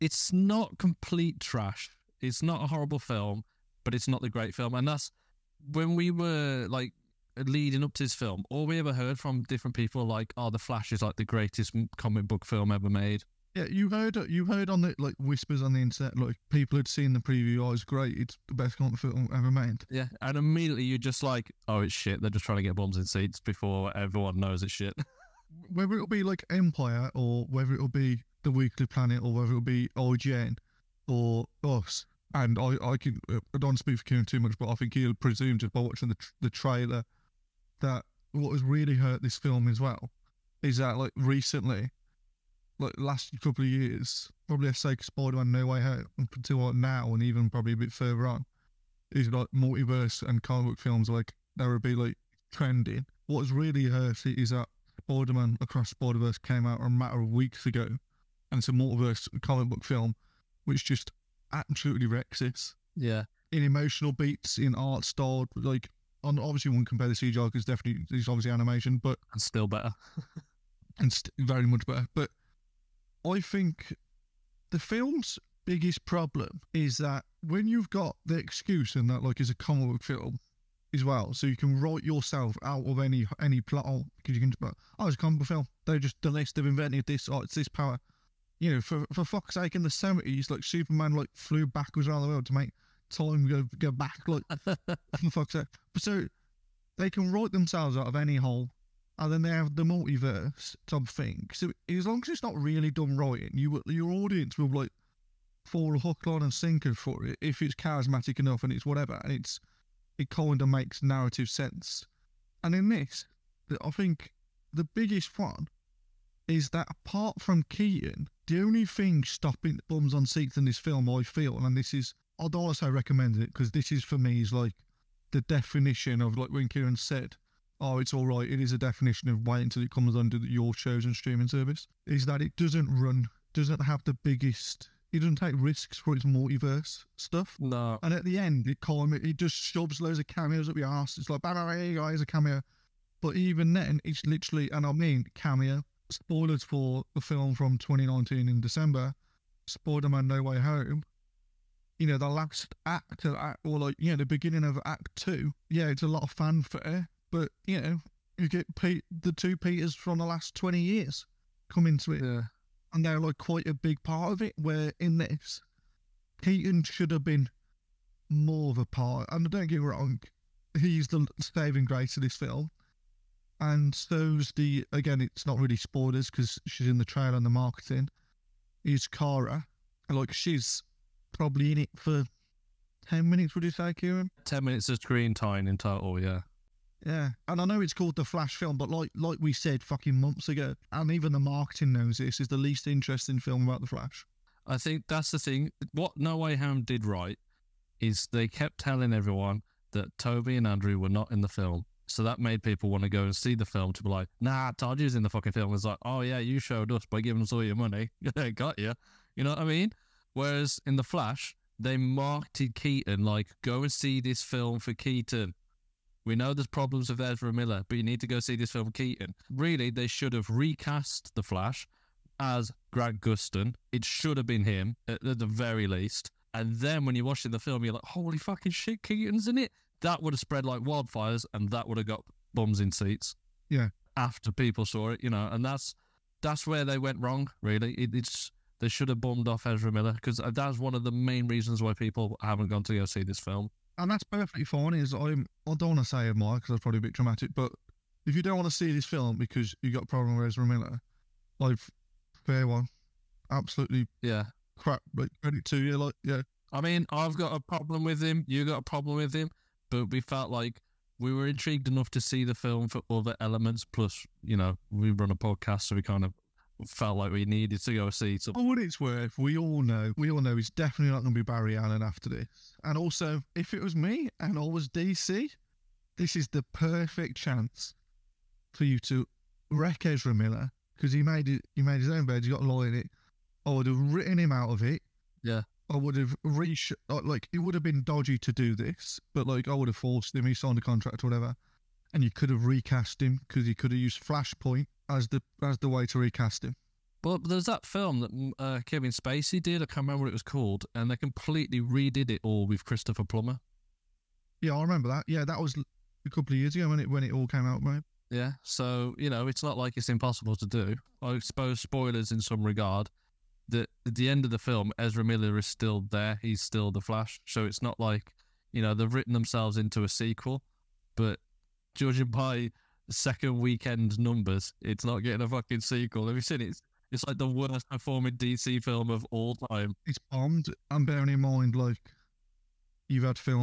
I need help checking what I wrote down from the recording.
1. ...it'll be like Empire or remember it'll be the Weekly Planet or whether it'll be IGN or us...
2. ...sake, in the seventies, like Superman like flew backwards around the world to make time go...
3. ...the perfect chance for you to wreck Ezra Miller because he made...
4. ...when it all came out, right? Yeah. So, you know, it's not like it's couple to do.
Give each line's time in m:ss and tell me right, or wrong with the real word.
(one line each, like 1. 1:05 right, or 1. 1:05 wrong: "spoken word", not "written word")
1. 0:25 wrong: "whether", not "remember"
2. 1:29 right
3. 4:36 right
4. 5:07 wrong: "impossible", not "couple".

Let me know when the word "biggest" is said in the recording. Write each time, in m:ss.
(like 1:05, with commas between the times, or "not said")
1:15, 1:54, 2:14.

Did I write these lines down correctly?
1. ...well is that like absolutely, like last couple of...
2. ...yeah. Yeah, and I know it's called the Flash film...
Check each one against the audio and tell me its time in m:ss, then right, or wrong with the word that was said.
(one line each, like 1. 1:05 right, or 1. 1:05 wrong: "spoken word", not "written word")
1. 0:39 wrong: "recently", not "absolutely"
2. 3:06 right.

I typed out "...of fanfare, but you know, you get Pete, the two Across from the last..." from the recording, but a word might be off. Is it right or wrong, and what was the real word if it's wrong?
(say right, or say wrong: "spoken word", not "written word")
wrong: "Peters", not "Across".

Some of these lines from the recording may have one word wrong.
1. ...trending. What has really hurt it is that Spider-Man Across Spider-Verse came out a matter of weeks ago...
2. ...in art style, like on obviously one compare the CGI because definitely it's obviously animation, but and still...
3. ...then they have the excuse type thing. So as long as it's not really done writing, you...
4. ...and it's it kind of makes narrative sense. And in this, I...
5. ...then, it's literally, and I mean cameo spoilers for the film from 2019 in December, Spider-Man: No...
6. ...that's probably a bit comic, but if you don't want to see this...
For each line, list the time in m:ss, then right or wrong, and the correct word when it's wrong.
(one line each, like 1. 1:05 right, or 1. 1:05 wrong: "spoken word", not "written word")
1. 0:52 right
2. 1:04 right
3. 1:39 wrong: "multiverse", not "excuse"
4. 1:49 right
5. 2:23 right
6. 4:06 wrong: "dramatic", not "comic".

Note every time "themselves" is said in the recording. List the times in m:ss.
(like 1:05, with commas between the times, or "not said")
1:37, 5:19.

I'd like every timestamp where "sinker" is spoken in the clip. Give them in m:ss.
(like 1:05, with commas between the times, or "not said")
1:46.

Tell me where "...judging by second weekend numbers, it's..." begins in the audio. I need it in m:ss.
5:21.